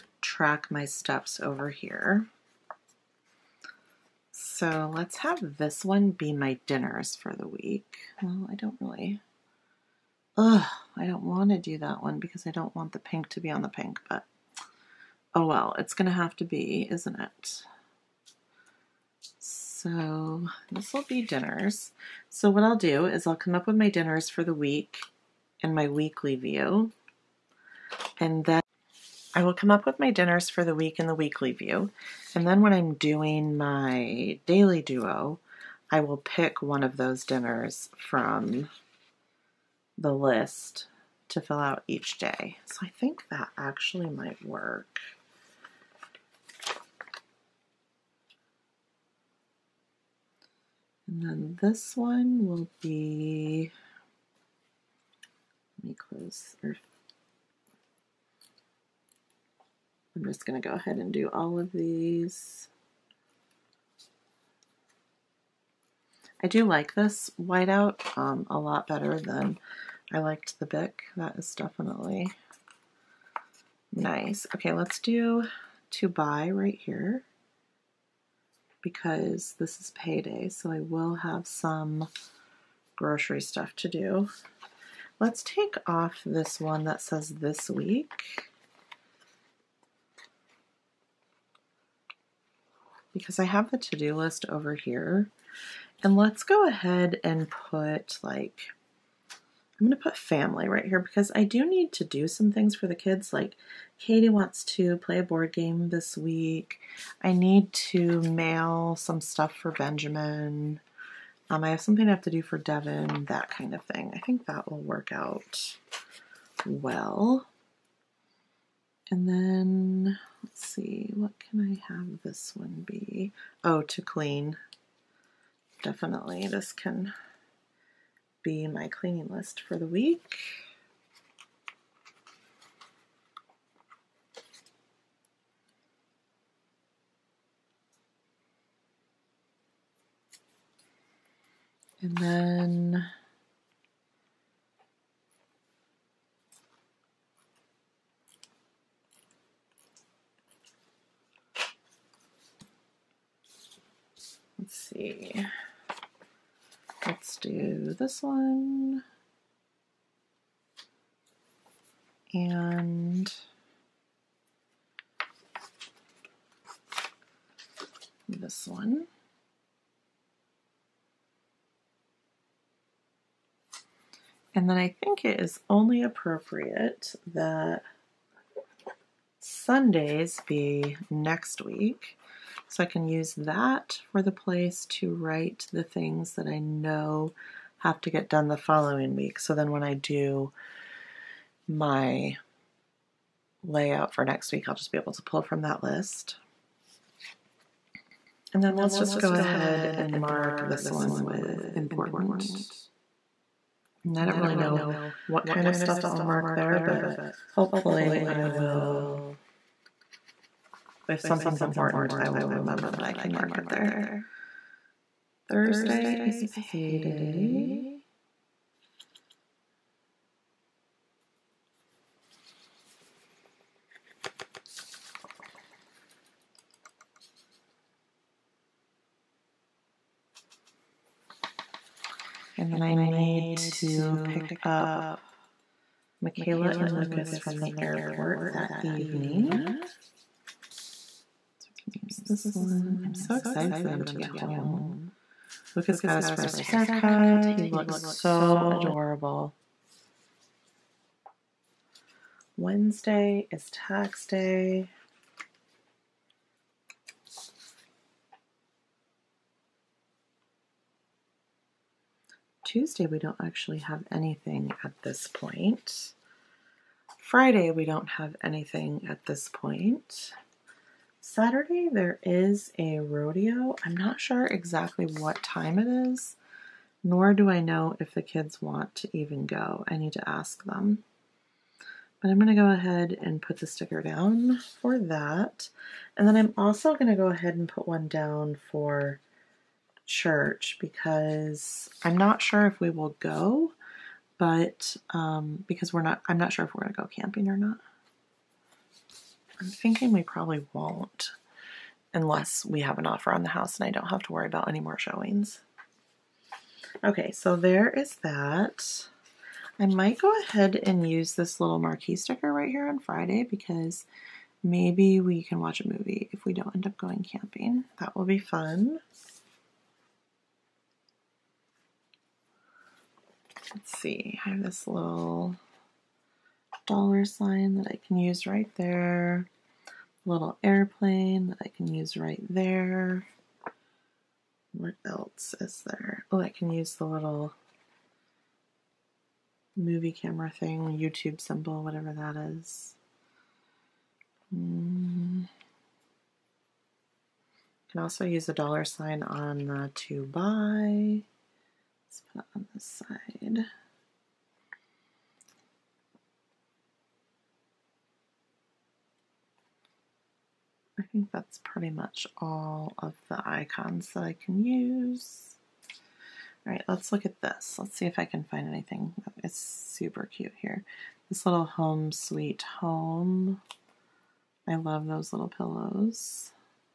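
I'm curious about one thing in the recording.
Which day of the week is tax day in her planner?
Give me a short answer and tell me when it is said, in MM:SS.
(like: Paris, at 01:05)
Wednesday, at 04:12.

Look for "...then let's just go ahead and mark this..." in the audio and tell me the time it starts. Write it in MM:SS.
03:18.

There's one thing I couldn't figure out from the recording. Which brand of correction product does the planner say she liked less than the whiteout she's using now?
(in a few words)
Bic.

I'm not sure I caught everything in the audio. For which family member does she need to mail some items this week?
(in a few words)
Benjamin.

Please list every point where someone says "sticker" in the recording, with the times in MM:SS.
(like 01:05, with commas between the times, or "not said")
04:43, 05:12.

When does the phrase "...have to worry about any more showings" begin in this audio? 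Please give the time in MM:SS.
05:04.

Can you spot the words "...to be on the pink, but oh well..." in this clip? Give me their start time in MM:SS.
00:13.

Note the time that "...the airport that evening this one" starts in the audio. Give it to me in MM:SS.
03:57.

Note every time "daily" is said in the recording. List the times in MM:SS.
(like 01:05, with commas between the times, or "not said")
00:34.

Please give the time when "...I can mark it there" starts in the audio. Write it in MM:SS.
03:33.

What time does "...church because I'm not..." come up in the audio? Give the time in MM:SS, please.
04:50.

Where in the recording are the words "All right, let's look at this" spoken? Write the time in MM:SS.
06:06.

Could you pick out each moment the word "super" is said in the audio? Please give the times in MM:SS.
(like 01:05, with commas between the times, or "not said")
06:09.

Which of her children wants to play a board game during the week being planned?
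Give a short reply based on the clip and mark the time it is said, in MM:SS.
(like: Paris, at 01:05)
Katie, at 01:43.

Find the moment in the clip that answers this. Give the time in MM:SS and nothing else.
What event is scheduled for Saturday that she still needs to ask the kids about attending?
04:32.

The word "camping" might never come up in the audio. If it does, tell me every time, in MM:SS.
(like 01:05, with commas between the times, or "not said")
04:57, 05:17.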